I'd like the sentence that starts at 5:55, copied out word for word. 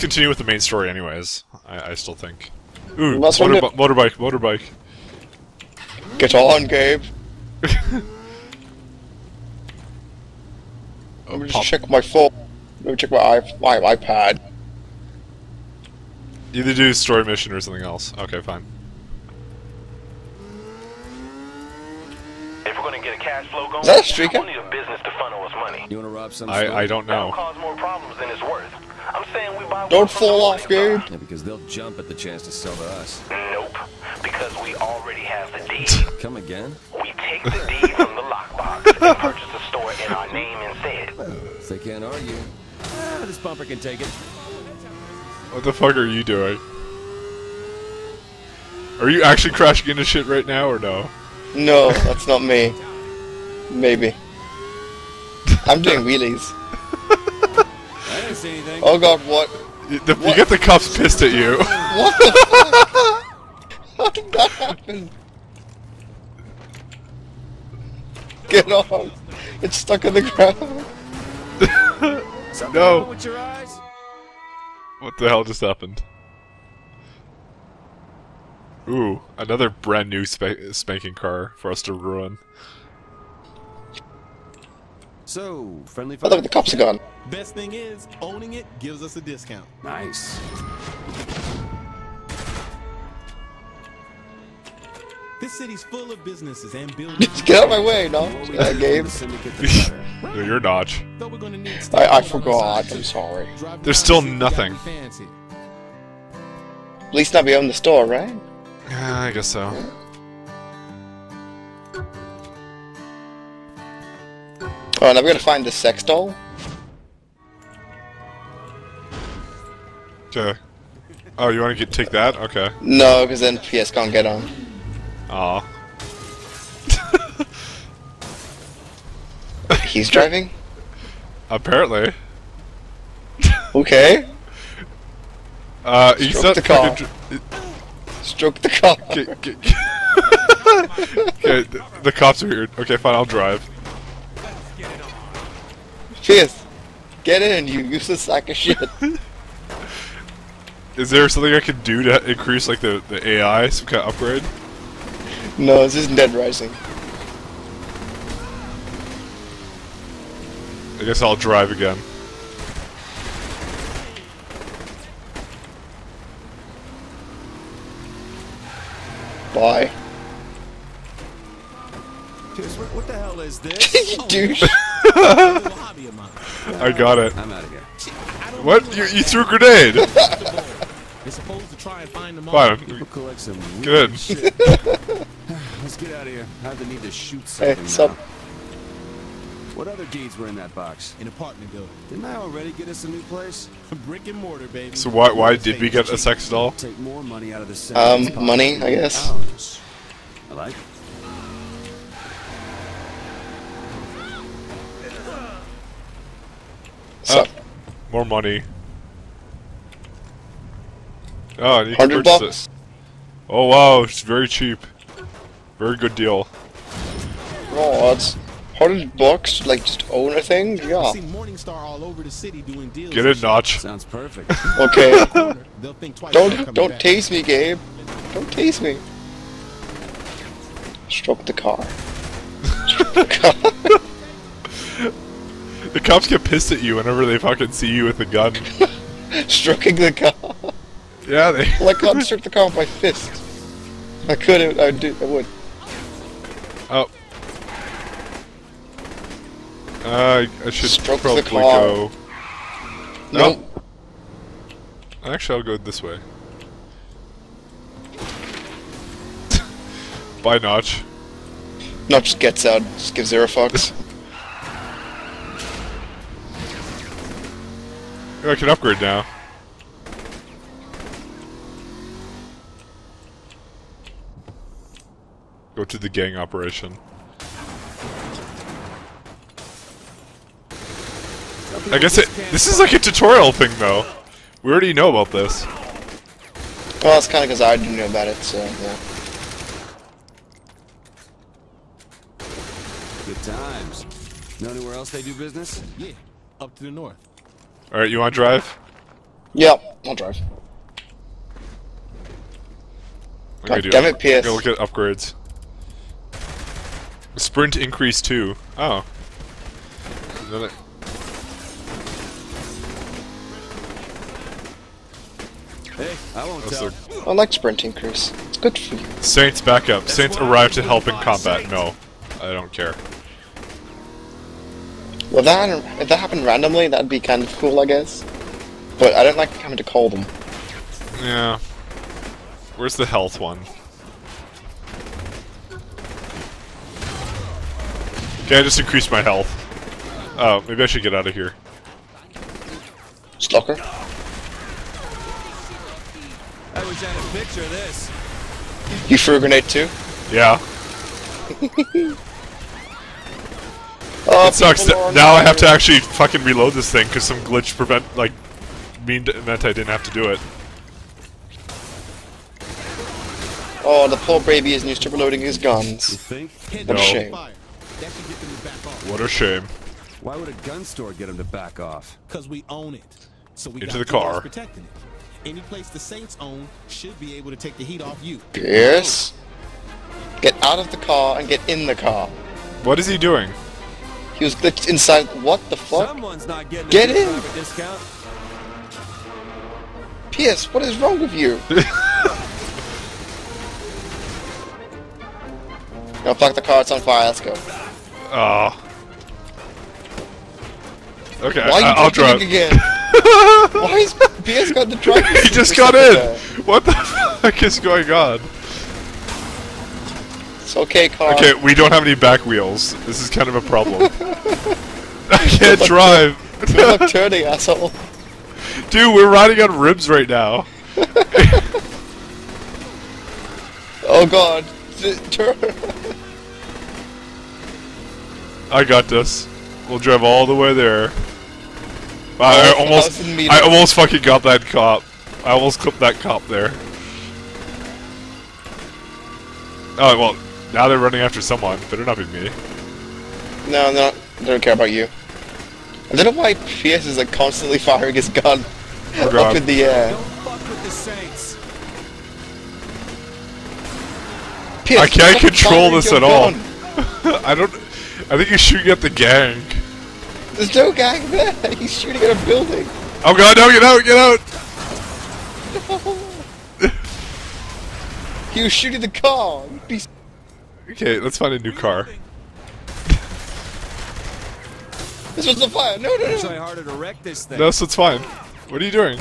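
Now I have to actually fucking reload this thing because some glitch prevent like mean meant I didn't have to do it.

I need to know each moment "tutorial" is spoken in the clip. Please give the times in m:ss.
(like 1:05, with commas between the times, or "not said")
4:42.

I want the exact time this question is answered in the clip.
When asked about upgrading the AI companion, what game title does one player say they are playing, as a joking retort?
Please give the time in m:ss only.
2:36.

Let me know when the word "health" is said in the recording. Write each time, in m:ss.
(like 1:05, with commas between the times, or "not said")
5:33, 5:39.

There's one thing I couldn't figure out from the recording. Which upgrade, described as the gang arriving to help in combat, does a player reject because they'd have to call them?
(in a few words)
Saints back up.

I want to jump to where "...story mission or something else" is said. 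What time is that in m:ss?
0:16.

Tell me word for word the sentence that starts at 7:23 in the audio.
No, no, they don't care about you.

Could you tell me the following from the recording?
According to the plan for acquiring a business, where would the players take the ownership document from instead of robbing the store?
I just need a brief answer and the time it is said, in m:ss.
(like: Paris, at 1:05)
The lockbox, at 0:38.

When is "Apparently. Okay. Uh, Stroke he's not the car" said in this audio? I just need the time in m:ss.
2:11.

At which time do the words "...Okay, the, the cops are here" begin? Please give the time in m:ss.
2:20.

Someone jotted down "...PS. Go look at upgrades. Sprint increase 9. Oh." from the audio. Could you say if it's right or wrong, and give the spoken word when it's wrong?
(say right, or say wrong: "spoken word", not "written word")
wrong: "2", not "9".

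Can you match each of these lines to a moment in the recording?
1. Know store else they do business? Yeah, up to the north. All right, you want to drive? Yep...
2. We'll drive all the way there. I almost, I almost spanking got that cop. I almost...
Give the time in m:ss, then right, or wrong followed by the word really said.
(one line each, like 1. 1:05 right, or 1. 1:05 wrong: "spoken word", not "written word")
1. 4:54 wrong: "anywhere", not "store"
2. 7:09 wrong: "fucking", not "spanking".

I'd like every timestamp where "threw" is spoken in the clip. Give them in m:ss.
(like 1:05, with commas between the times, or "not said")
2:59, 5:49.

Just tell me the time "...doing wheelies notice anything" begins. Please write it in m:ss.
0:55.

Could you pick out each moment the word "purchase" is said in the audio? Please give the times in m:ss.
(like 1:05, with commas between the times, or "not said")
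0:39, 3:32.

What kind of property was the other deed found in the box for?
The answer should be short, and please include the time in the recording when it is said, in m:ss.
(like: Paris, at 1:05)
An apartment building, at 3:11.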